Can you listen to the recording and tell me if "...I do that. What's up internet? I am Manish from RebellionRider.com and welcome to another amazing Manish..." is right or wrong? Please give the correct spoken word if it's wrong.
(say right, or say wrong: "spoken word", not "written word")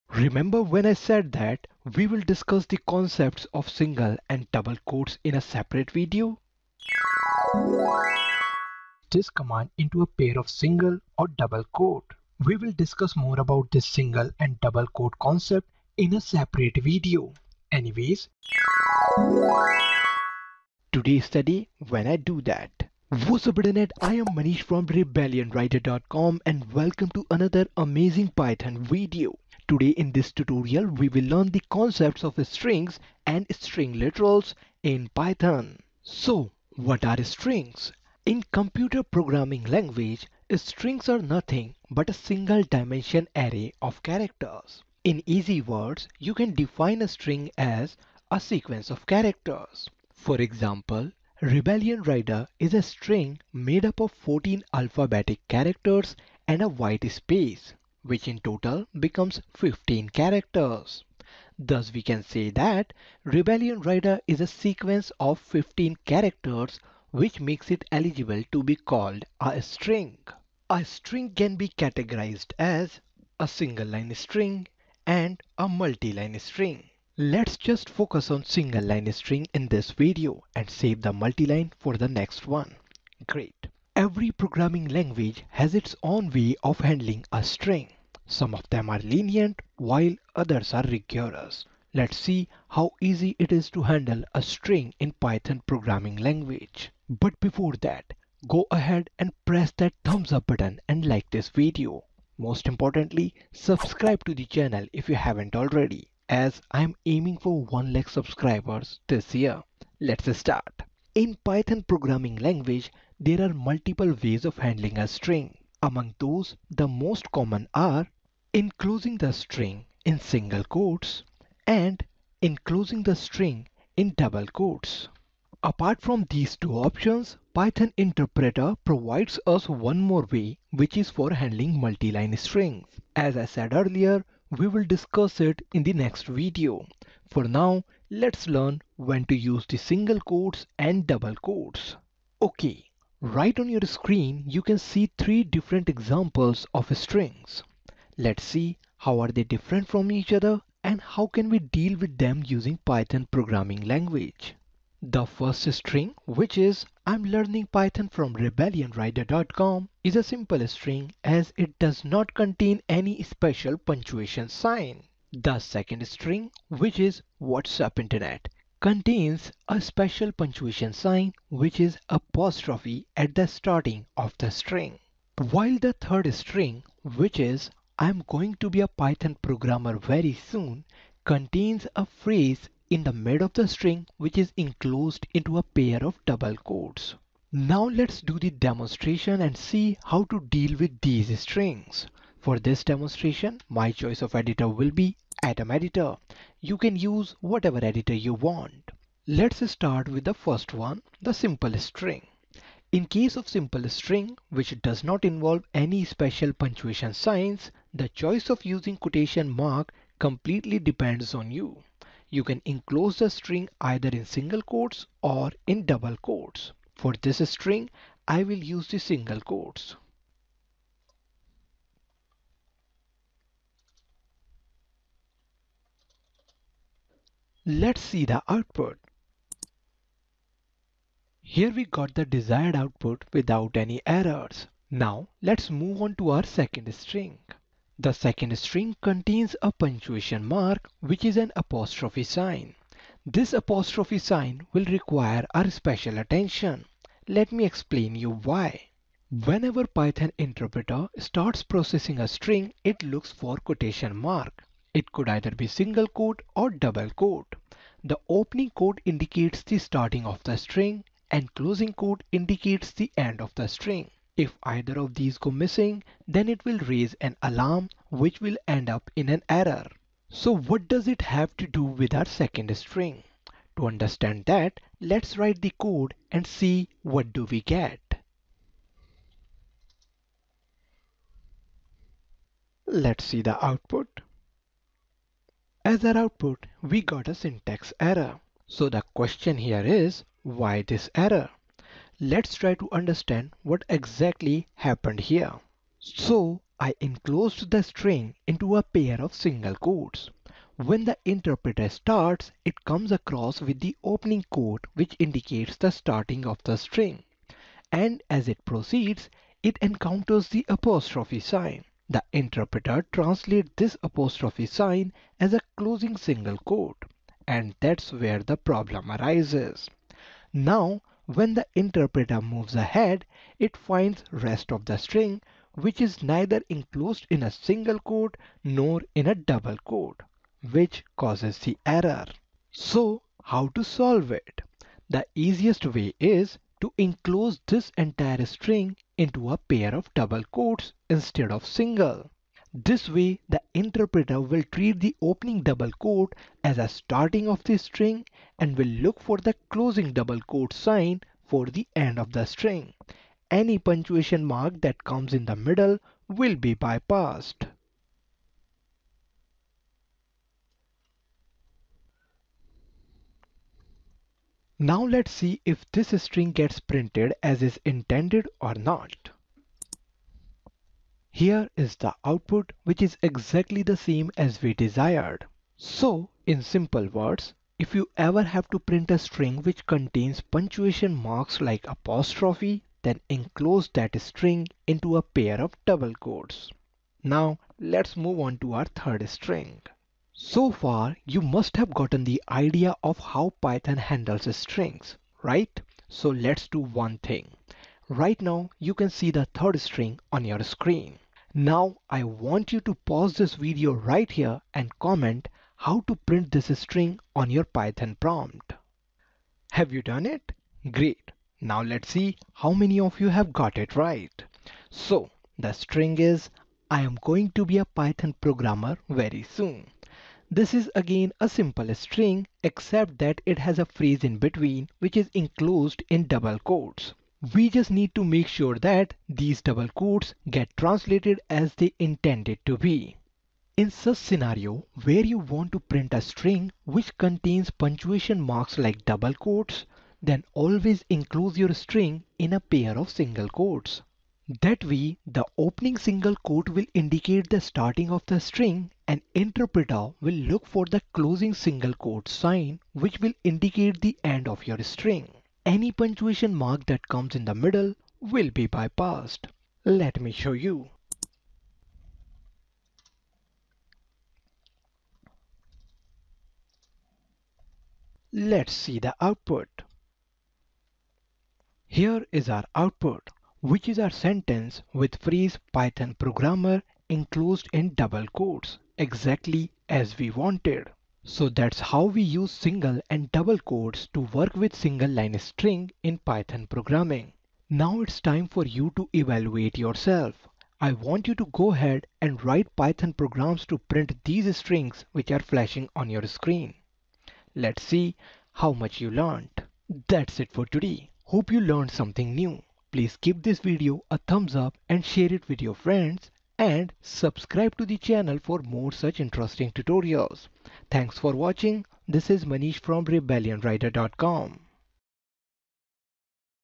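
wrong: "Python", not "Manish".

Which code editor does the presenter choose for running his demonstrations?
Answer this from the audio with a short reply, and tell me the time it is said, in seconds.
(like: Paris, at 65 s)
Atom Editor, at 195 s.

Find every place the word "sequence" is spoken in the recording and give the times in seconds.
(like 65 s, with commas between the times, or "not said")
48 s, 64 s.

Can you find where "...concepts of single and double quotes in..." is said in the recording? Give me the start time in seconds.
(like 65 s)
2 s.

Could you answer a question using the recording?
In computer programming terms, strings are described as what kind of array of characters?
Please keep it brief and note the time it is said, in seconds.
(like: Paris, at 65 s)
Single dimension array, at 42 s.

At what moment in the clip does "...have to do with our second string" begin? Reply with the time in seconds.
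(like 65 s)
271 s.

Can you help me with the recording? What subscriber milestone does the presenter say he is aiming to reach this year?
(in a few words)
1 lakh.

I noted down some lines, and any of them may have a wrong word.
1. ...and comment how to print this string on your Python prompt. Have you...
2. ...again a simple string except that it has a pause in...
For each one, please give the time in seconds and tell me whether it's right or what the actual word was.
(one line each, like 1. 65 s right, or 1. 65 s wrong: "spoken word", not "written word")
1. 404 s right
2. 420 s wrong: "phrase", not "pause".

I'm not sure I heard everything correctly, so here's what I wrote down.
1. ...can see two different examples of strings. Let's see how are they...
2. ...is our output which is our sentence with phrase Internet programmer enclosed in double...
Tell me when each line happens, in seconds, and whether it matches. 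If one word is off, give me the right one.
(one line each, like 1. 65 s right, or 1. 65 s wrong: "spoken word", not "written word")
1. 144 s wrong: "three", not "two"
2. 472 s wrong: "Python", not "Internet".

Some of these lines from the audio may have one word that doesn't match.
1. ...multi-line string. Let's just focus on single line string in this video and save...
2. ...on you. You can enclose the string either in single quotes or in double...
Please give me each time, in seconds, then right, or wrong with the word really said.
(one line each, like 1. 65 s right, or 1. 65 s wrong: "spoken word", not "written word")
1. 75 s right
2. 211 s right.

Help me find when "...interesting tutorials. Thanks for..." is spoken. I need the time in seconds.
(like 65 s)
509 s.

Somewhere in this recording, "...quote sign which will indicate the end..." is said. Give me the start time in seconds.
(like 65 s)
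451 s.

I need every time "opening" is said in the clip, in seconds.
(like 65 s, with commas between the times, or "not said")
258 s, 304 s, 345 s, 445 s.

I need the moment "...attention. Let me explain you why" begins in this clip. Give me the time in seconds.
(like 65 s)
246 s.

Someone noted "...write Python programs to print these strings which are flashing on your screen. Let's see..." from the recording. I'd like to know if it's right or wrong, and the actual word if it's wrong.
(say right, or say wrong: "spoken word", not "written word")
right.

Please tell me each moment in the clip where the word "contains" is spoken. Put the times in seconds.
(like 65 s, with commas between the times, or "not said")
162 s, 168 s, 181 s, 239 s, 379 s, 437 s.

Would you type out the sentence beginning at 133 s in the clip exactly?
As I said earlier, we will discuss it in the next video.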